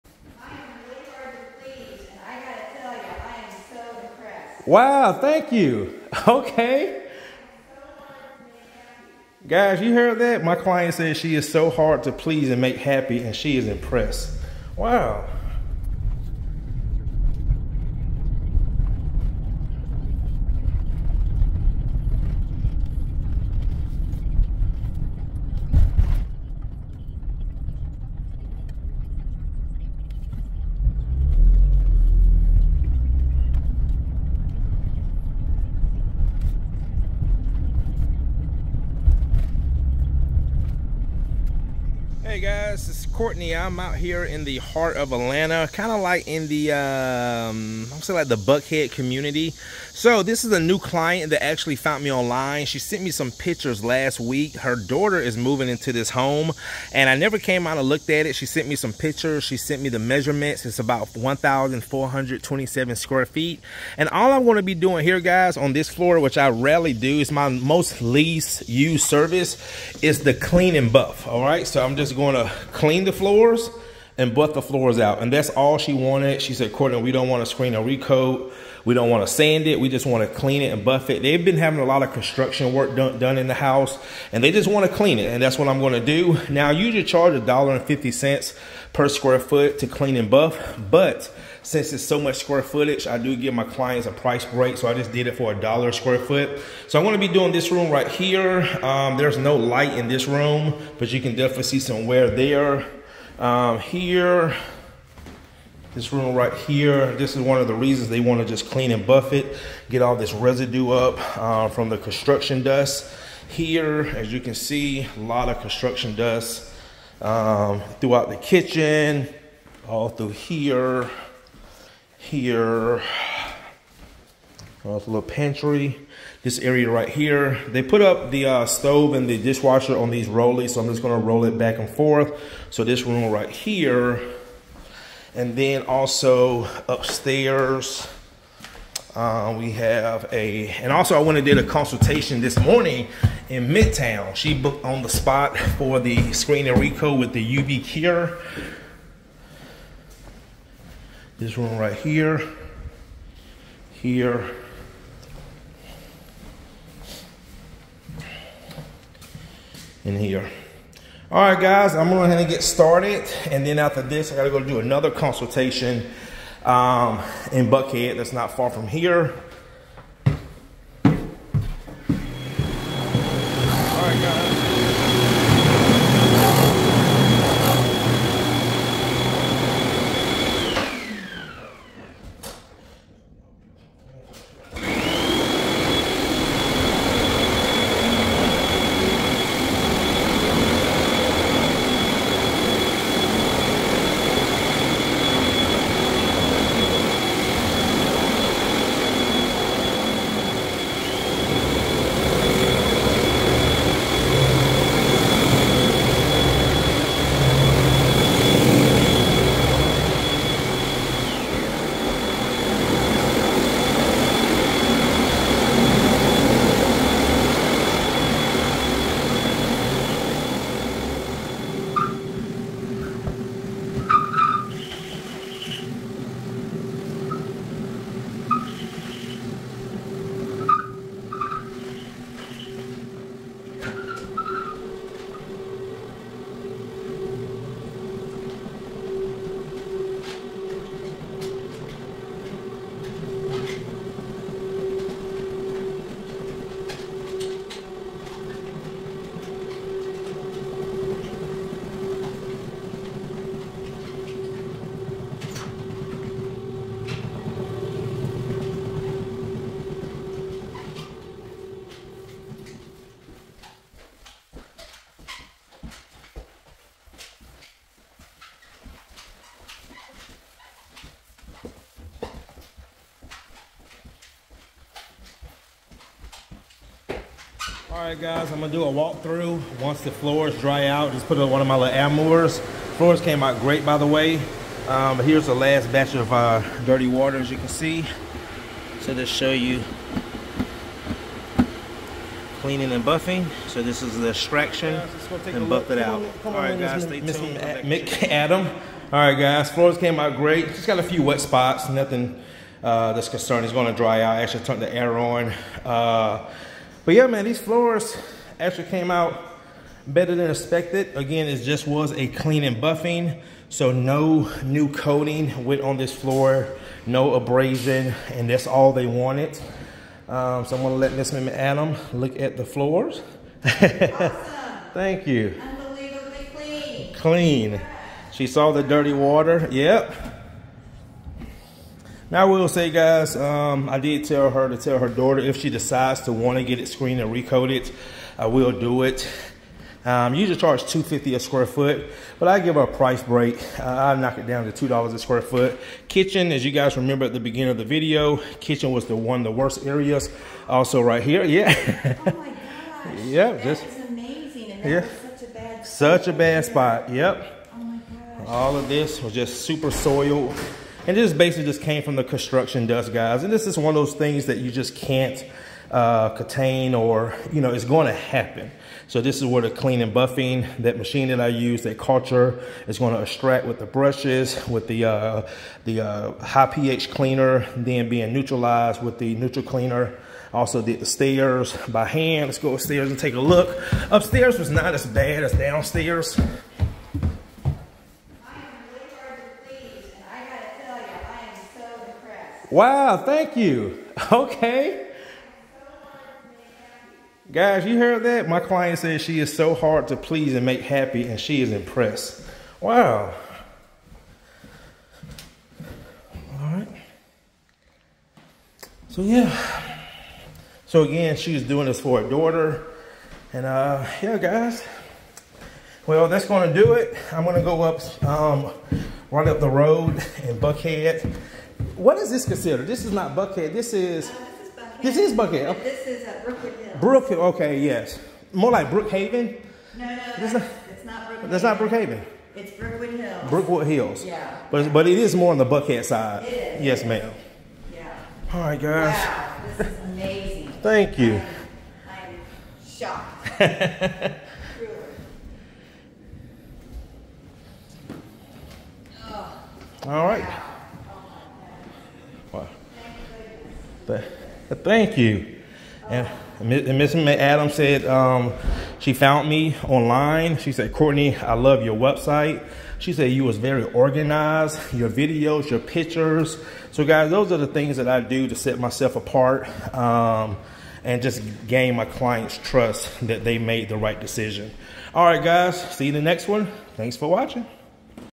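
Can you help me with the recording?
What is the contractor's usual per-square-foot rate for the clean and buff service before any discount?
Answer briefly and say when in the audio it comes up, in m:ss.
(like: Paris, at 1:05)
$1.50, at 1:27.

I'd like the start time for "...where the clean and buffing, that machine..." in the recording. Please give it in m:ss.
6:09.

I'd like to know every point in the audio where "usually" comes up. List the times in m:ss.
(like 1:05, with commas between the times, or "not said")
1:26, 5:40.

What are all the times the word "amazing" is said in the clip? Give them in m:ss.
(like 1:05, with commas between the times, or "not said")
5:54, 7:19.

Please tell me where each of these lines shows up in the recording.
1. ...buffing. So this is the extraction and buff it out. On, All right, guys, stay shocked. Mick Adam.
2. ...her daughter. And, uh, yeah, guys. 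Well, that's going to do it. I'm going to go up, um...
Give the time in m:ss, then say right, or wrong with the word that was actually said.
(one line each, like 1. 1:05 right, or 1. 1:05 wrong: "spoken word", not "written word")
1. 4:53 wrong: "tuned", not "shocked"
2. 6:52 right.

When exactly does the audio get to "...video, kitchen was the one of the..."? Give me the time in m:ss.
5:47.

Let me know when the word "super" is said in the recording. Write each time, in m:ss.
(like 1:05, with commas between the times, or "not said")
5:59.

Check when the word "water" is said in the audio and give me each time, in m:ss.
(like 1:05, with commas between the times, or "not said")
4:47, 5:29.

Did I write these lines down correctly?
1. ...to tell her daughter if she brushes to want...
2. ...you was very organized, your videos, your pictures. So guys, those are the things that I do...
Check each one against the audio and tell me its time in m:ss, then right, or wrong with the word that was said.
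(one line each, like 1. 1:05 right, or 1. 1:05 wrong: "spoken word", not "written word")
1. 5:34 wrong: "decides", not "brushes"
2. 7:43 right.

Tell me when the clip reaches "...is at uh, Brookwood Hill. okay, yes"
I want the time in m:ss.
7:06.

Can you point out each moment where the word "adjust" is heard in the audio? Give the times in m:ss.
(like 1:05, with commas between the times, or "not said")
not said.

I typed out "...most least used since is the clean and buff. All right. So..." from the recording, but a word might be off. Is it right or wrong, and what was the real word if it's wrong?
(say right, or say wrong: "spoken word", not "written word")
wrong: "service", not "since".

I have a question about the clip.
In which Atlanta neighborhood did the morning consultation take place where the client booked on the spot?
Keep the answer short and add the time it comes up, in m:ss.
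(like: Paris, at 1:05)
Midtown, at 2:23.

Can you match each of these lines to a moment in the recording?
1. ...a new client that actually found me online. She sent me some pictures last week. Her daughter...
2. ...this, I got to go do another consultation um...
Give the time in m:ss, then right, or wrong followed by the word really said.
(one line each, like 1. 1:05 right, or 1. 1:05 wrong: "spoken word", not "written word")
1. 0:50 right
2. 2:44 right.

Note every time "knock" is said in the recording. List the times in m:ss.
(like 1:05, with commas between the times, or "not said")
5:44.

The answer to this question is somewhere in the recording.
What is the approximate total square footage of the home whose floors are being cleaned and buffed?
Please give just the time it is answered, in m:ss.
1:01.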